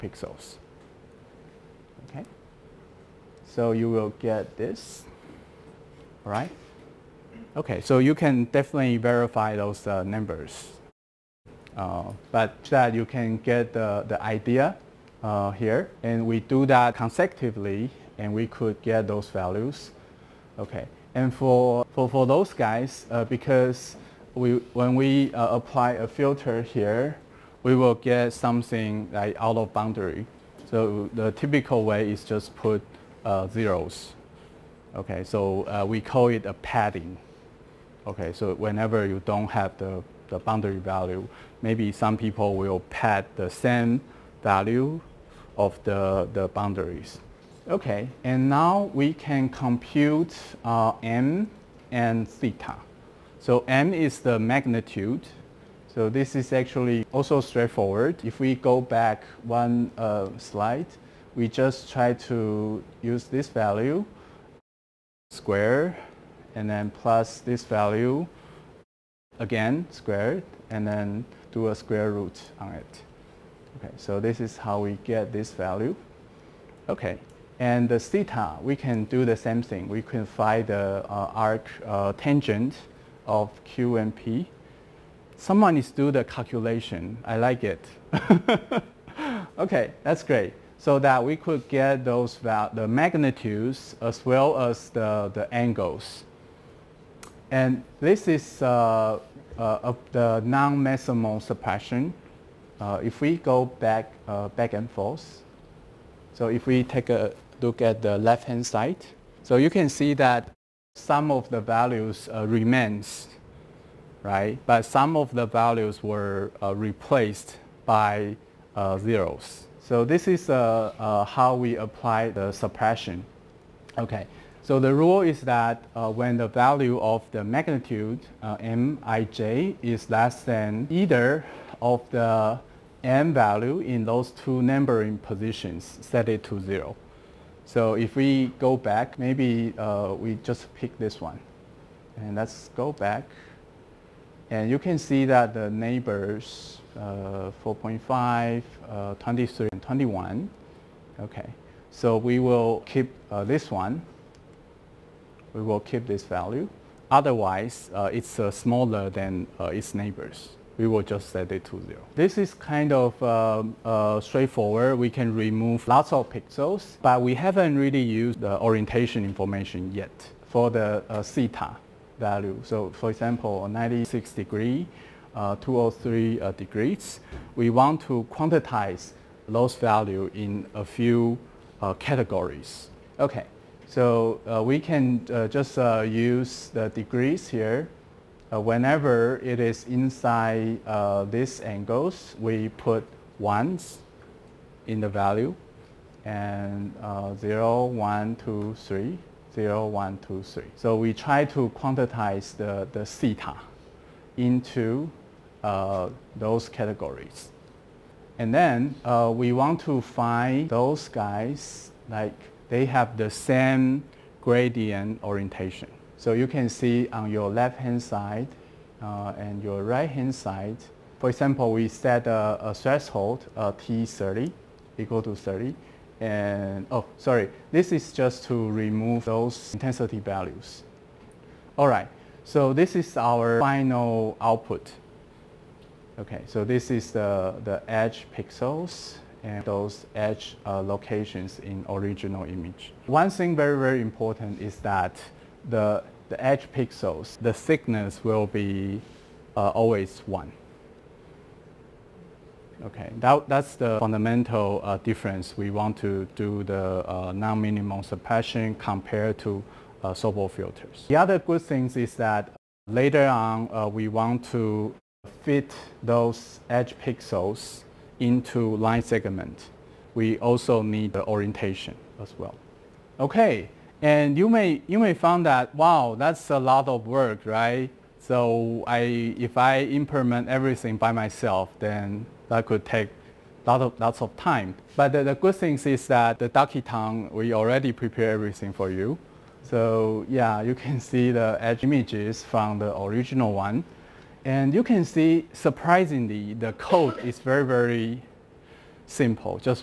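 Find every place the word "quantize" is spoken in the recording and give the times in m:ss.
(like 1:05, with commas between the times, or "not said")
2:58, 3:21.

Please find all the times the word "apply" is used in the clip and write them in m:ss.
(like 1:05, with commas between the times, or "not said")
0:25, 2:01.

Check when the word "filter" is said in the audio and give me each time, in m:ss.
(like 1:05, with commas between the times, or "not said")
0:26, 4:20.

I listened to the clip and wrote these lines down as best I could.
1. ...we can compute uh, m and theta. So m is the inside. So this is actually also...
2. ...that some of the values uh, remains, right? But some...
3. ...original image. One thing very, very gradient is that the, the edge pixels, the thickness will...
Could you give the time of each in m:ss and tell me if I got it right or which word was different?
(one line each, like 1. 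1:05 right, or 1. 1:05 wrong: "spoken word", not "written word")
1. 0:48 wrong: "magnitude", not "inside"
2. 1:50 right
3. 4:01 wrong: "important", not "gradient".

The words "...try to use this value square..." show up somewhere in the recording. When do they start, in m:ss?
1:01.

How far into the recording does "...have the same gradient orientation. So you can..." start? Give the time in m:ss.
3:32.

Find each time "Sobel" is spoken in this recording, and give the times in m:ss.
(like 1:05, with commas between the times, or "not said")
4:20.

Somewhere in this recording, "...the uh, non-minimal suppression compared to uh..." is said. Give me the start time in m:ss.
4:16.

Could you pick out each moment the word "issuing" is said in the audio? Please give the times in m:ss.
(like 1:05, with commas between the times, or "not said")
not said.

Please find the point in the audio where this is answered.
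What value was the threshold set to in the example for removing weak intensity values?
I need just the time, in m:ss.
3:45.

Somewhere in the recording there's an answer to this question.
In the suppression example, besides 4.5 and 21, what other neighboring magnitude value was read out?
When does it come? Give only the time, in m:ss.
2:29.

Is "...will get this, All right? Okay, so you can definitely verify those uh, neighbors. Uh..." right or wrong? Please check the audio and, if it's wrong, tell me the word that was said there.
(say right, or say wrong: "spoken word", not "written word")
wrong: "numbers", not "neighbors".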